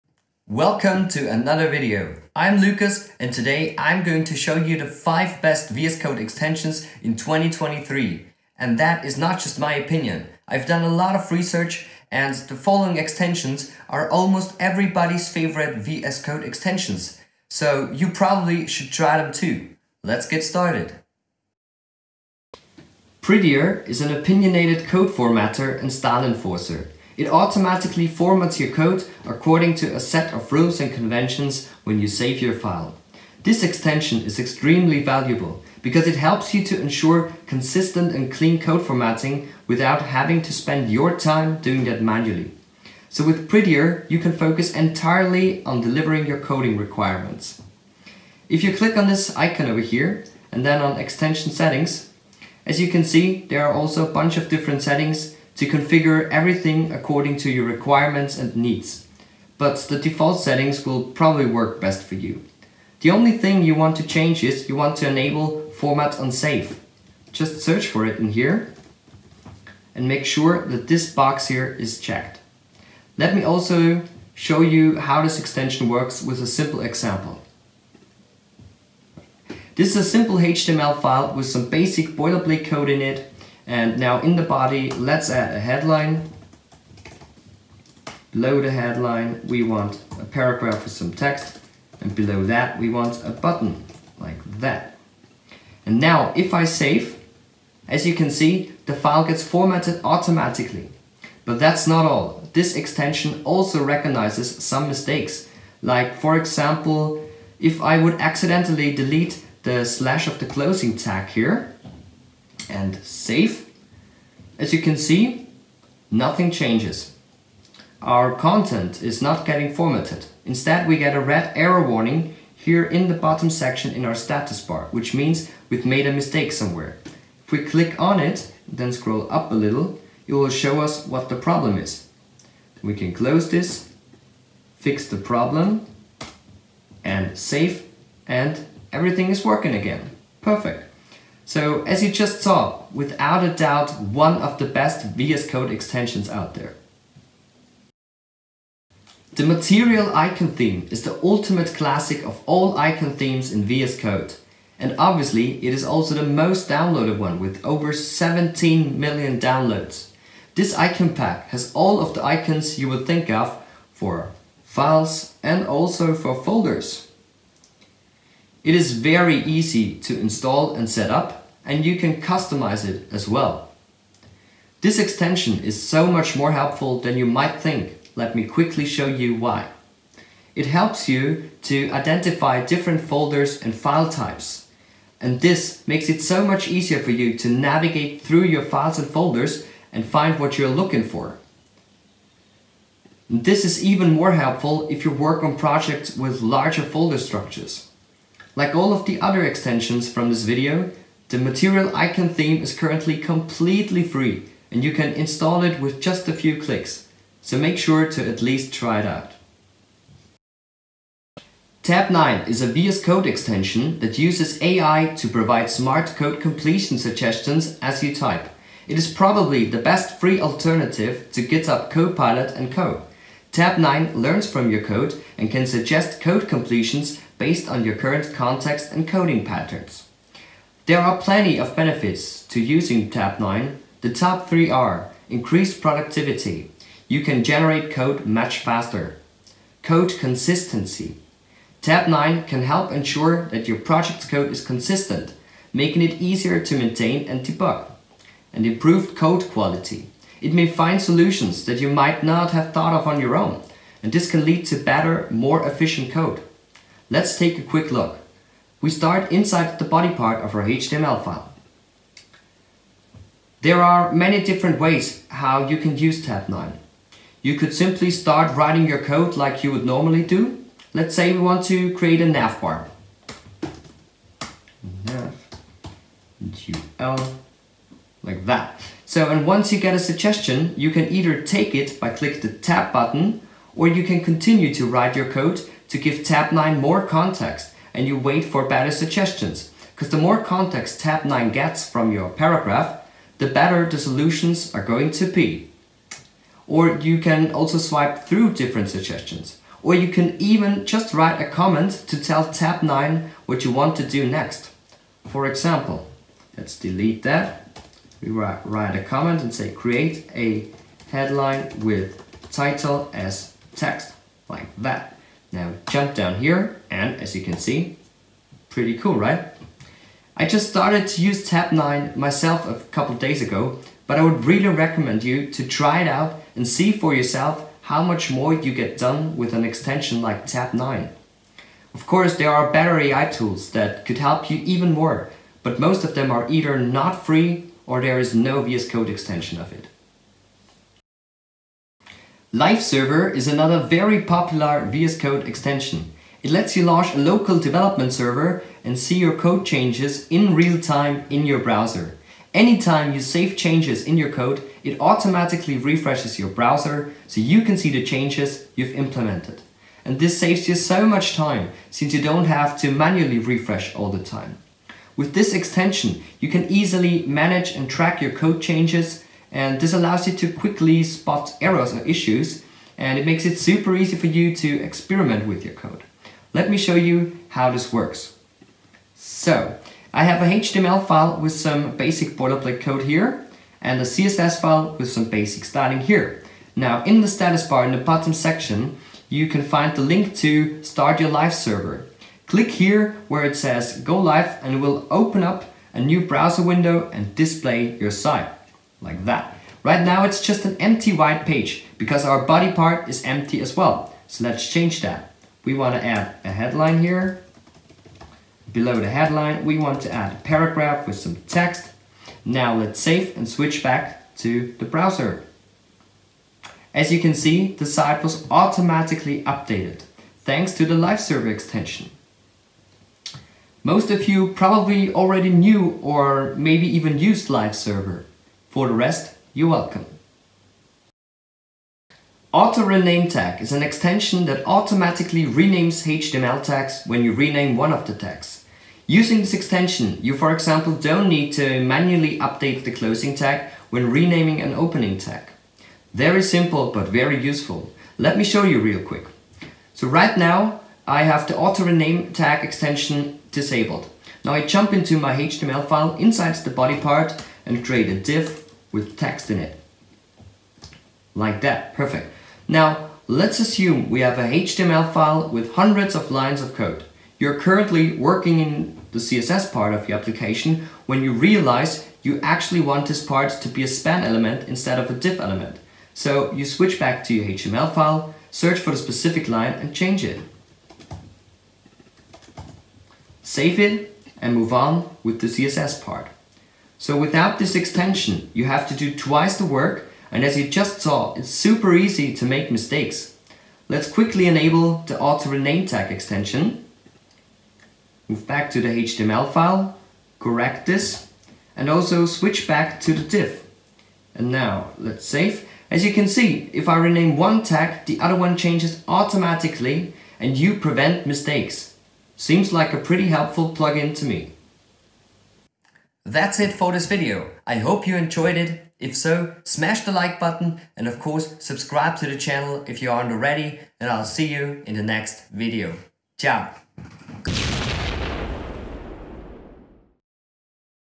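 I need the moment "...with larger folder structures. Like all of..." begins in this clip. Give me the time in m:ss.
3:16.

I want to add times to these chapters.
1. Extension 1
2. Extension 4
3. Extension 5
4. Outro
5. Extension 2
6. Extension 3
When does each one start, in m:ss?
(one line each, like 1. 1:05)
1. 0:21
2. 5:41
3. 7:11
4. 8:35
5. 2:28
6. 3:30.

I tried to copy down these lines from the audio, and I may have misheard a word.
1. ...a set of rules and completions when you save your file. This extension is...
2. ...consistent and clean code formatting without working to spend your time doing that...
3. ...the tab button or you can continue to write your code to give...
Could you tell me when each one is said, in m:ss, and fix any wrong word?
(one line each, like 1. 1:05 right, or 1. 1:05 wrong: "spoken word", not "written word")
1. 0:29 wrong: "conventions", not "completions"
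2. 0:37 wrong: "having", not "working"
3. 4:42 right.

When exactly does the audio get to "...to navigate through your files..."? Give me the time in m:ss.
3:07.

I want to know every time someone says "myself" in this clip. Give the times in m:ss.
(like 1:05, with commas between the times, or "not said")
5:22.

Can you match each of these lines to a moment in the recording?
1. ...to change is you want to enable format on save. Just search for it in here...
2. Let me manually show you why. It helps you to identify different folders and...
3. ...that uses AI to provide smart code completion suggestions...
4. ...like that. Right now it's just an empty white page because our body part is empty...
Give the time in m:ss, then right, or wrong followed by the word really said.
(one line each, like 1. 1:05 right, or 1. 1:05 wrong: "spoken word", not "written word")
1. 1:03 right
2. 2:58 wrong: "quickly", not "manually"
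3. 3:34 right
4. 6:39 right.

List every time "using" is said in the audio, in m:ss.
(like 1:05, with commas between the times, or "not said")
3:52, 7:19.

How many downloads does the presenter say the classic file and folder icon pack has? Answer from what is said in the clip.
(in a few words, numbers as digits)
over 17 million.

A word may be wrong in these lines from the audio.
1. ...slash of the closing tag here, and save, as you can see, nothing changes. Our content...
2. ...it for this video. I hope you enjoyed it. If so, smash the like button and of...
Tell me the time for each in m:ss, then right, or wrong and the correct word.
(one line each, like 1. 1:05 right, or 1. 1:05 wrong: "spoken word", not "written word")
1. 1:49 right
2. 8:36 right.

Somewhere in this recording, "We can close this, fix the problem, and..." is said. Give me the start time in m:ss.
2:12.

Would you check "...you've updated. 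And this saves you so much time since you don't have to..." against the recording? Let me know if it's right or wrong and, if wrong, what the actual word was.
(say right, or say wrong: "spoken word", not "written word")
wrong: "implemented", not "updated".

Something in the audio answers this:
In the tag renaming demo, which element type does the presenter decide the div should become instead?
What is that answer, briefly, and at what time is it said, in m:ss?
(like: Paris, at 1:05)
span, at 7:53.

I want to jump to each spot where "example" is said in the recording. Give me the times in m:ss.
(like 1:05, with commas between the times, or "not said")
1:16, 1:46, 5:05, 7:20.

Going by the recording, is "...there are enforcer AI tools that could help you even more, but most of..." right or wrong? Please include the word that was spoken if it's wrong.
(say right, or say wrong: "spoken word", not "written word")
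wrong: "better", not "enforcer".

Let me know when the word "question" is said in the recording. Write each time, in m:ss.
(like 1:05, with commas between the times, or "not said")
not said.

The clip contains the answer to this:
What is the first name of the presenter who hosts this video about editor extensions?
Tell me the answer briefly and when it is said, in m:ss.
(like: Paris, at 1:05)
Lukas, at 0:02.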